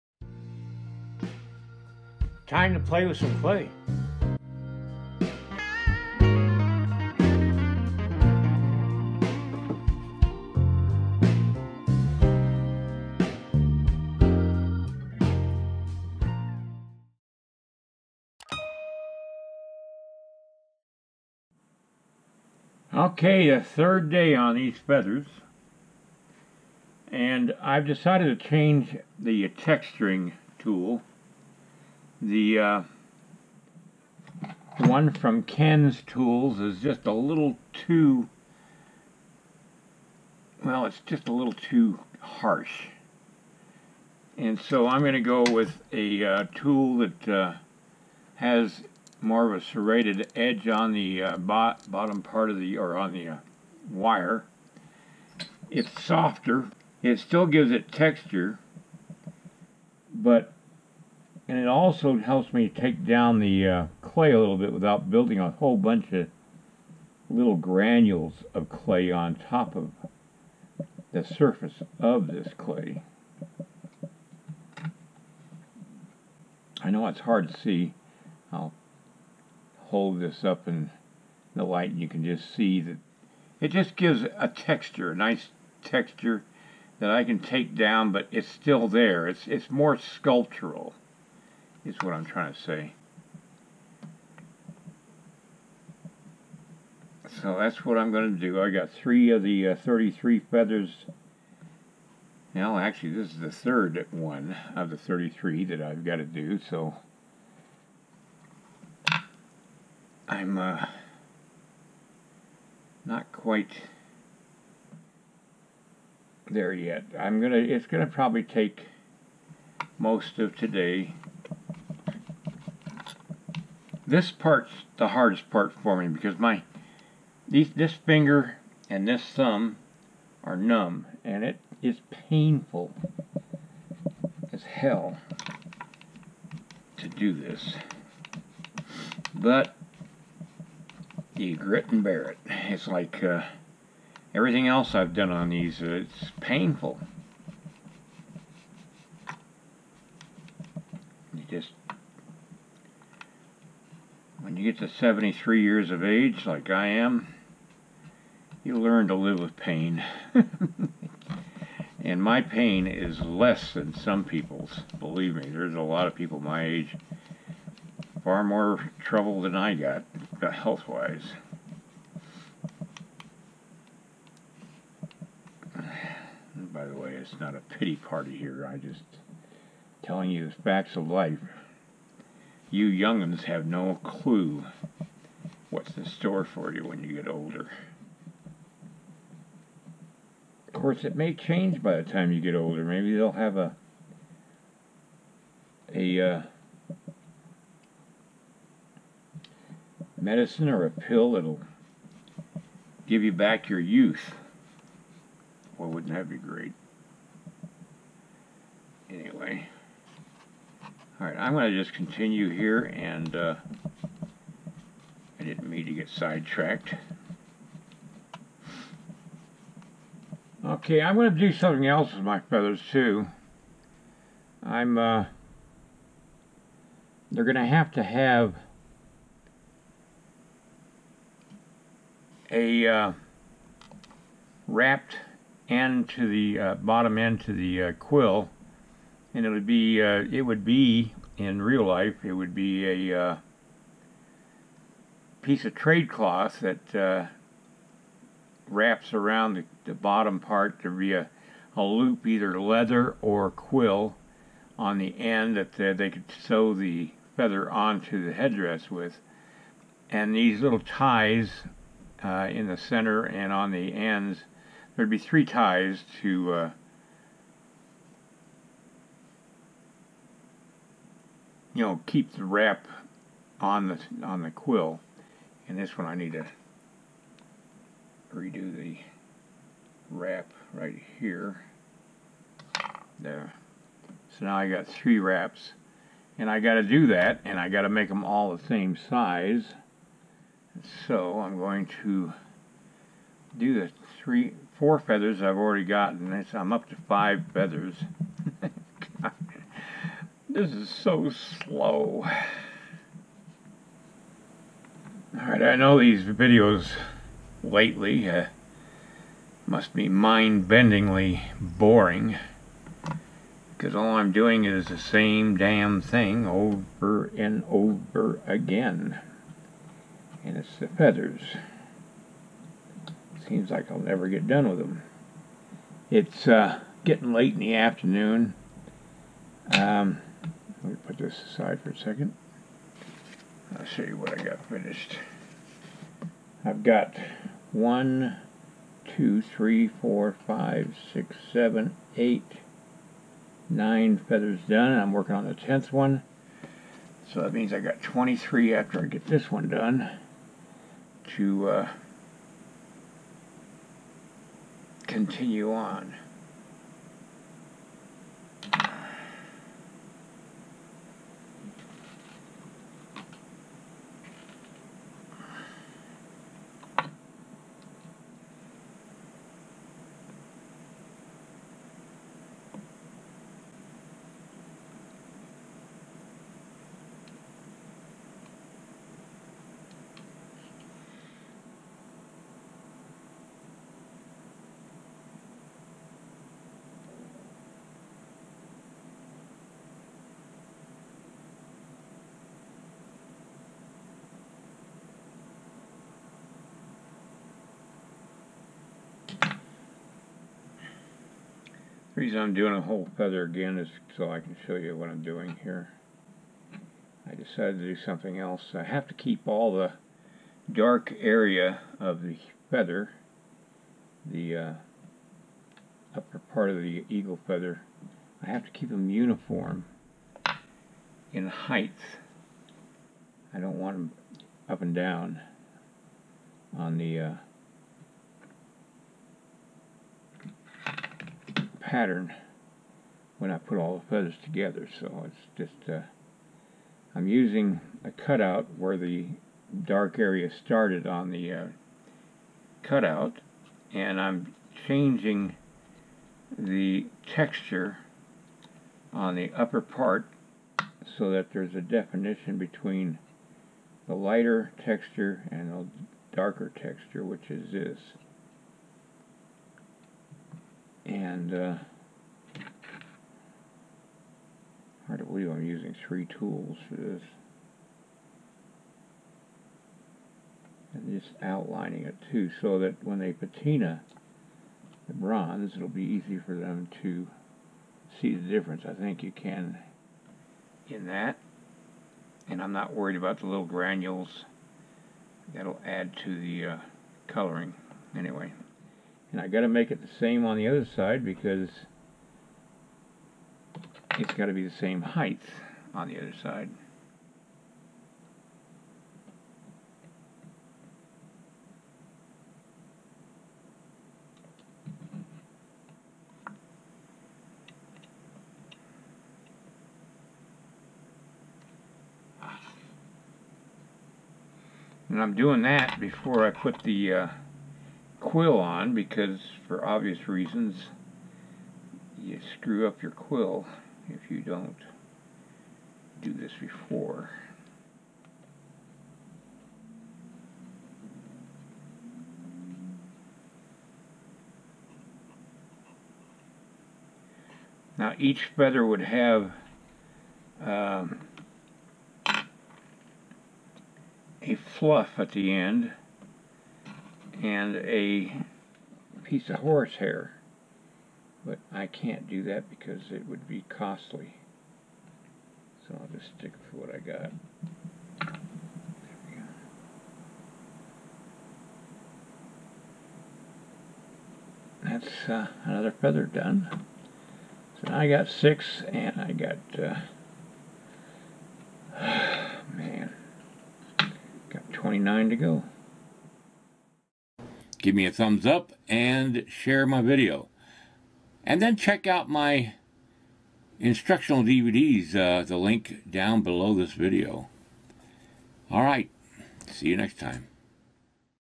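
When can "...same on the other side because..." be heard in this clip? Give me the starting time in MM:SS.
08:10.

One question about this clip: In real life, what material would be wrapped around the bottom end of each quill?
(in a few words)
trade cloth.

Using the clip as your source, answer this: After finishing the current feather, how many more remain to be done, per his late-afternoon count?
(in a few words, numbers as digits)
23.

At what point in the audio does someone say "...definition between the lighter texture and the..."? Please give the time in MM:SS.
07:31.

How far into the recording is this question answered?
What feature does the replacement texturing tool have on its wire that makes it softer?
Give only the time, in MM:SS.
00:49.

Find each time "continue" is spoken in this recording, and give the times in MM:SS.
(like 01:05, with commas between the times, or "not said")
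03:31, 05:55.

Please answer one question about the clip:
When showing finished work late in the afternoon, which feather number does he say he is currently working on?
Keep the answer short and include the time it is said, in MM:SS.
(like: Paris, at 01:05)
10th, at 05:45.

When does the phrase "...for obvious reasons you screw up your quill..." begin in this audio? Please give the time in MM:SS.
08:39.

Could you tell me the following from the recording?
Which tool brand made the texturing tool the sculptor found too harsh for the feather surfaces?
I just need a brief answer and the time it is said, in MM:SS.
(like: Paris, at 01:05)
Ken's Tools, at 00:35.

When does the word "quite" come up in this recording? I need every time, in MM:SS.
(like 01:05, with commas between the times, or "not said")
01:53.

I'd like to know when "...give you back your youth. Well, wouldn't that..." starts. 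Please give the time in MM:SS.
03:23.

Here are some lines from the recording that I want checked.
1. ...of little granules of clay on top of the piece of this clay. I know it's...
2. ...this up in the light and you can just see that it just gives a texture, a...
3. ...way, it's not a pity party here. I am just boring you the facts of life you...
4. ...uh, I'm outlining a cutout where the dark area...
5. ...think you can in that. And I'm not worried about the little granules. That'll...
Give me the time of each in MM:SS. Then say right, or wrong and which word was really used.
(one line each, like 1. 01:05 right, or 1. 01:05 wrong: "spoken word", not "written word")
1. 01:06 wrong: "surface", not "piece"
2. 01:20 right
3. 02:56 wrong: "telling", not "boring"
4. 07:15 wrong: "using", not "outlining"
5. 07:58 right.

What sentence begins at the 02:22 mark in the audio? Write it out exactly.
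It's like uh, everything else I've done on these, uh, it's painful.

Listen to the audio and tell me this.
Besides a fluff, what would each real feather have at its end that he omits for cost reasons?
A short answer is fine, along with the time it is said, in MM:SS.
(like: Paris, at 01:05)
horsehair, at 09:09.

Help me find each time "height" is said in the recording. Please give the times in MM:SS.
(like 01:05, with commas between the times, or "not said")
07:01, 08:15.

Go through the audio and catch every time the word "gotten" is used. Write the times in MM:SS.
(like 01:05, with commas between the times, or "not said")
04:55.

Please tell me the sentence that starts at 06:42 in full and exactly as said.
The reason I'm doing a whole feather again is so I can show you what I'm doing here.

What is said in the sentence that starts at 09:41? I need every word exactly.
And then check out my instructional DVDs, uh, the link down below this video.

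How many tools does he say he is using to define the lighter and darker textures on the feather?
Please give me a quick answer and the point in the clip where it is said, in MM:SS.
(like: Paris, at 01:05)
3, at 07:46.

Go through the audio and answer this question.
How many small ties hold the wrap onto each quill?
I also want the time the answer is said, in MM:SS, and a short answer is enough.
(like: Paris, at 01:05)
3, at 04:25.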